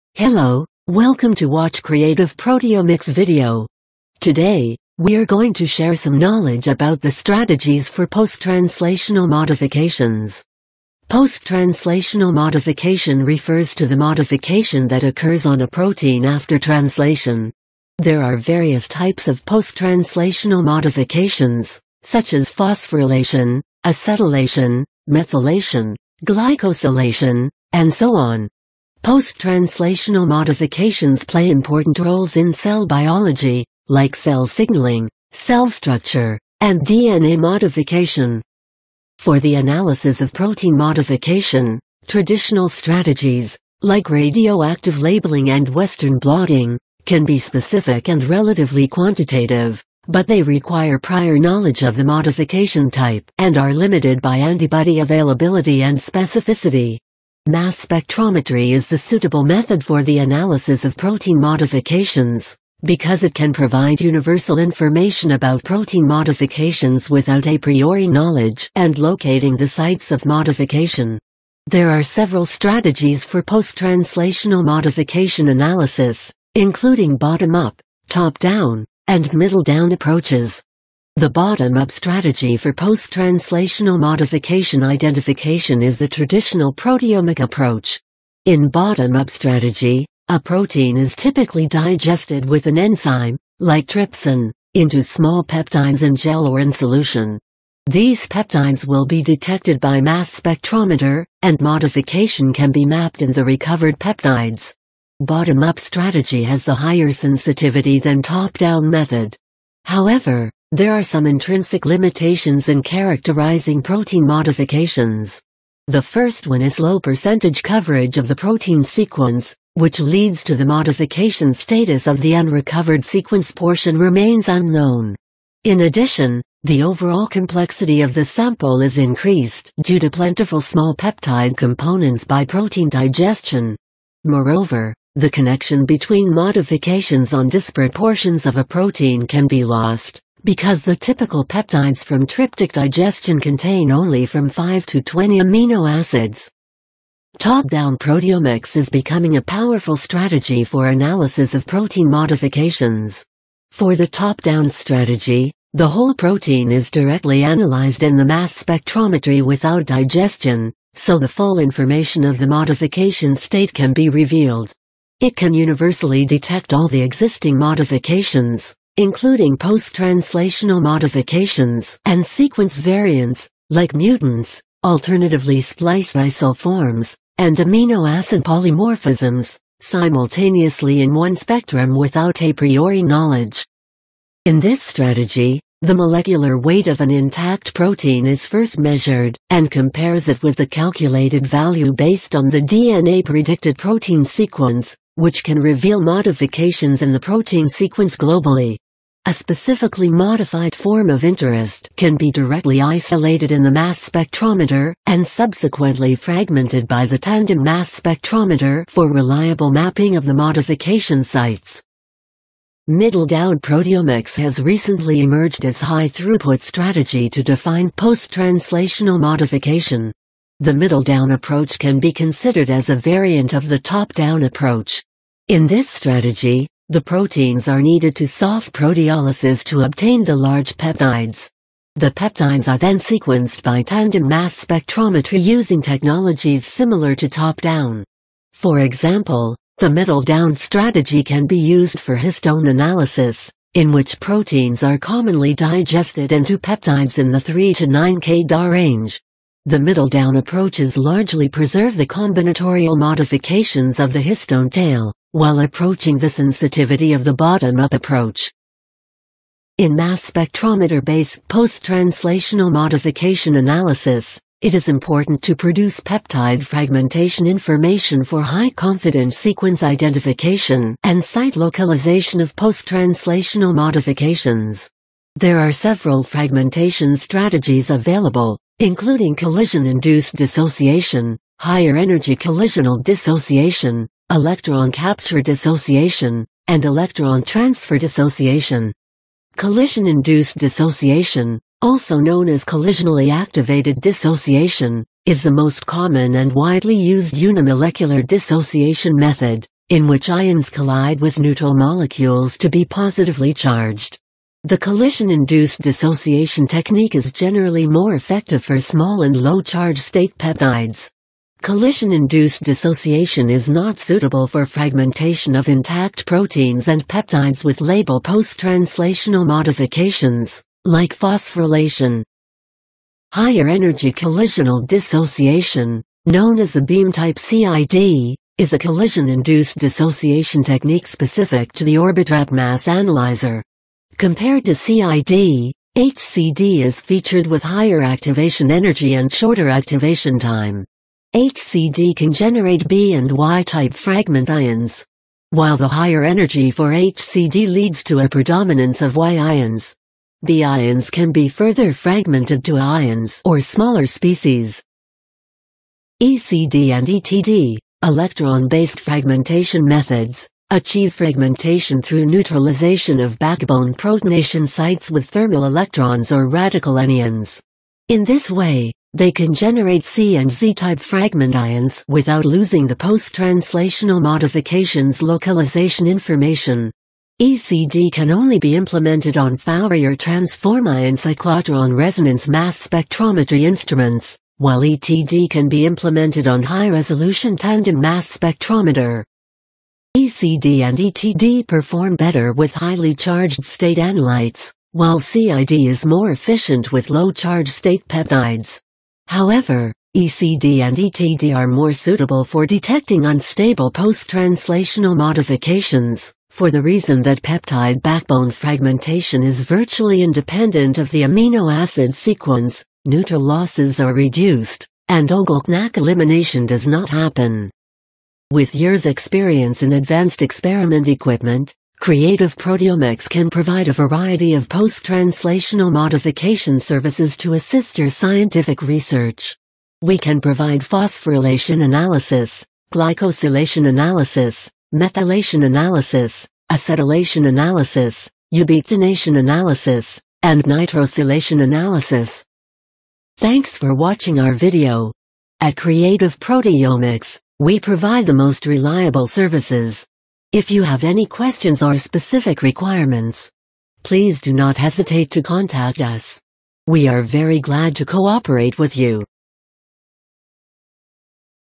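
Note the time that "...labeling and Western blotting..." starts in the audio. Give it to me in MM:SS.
00:45.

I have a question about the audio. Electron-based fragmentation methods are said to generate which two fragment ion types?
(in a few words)
C and Z-type.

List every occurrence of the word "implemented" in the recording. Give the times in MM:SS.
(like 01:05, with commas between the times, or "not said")
06:18, 06:25.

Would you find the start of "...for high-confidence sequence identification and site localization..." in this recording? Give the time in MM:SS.
04:28.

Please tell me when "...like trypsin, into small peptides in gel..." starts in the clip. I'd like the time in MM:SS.
01:33.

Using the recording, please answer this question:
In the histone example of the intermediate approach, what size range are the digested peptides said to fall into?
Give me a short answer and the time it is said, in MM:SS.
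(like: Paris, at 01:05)
3 to 9 kDa, at 04:07.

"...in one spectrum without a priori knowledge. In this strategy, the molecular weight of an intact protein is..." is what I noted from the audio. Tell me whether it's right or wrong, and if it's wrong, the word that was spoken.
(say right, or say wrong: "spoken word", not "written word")
right.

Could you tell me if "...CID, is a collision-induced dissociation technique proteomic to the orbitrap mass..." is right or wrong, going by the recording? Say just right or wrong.
wrong.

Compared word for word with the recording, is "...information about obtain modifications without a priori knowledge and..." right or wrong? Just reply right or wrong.
wrong.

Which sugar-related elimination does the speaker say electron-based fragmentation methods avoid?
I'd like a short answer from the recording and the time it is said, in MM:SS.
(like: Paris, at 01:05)
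O-GlcNAc elimination, at 06:55.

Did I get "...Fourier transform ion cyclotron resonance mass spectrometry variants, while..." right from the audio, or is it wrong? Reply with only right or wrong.
wrong.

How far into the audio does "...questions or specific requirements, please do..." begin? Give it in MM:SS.
07:31.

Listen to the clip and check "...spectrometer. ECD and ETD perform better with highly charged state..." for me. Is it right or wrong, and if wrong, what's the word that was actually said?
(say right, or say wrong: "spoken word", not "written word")
right.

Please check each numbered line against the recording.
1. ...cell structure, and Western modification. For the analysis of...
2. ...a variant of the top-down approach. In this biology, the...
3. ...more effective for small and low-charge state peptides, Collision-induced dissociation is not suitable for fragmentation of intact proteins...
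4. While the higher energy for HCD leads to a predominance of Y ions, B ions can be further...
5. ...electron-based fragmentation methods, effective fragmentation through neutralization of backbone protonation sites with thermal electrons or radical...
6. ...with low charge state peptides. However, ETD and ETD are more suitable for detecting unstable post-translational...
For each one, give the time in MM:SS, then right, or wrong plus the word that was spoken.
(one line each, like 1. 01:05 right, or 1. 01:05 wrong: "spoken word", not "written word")
1. 00:35 wrong: "DNA", not "Western"
2. 03:42 wrong: "strategy", not "biology"
3. 05:07 right
4. 05:45 right
5. 05:58 wrong: "achieve", not "effective"
6. 06:36 wrong: "ECD", not "ETD".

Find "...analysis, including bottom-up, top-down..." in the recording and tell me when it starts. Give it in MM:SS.
01:15.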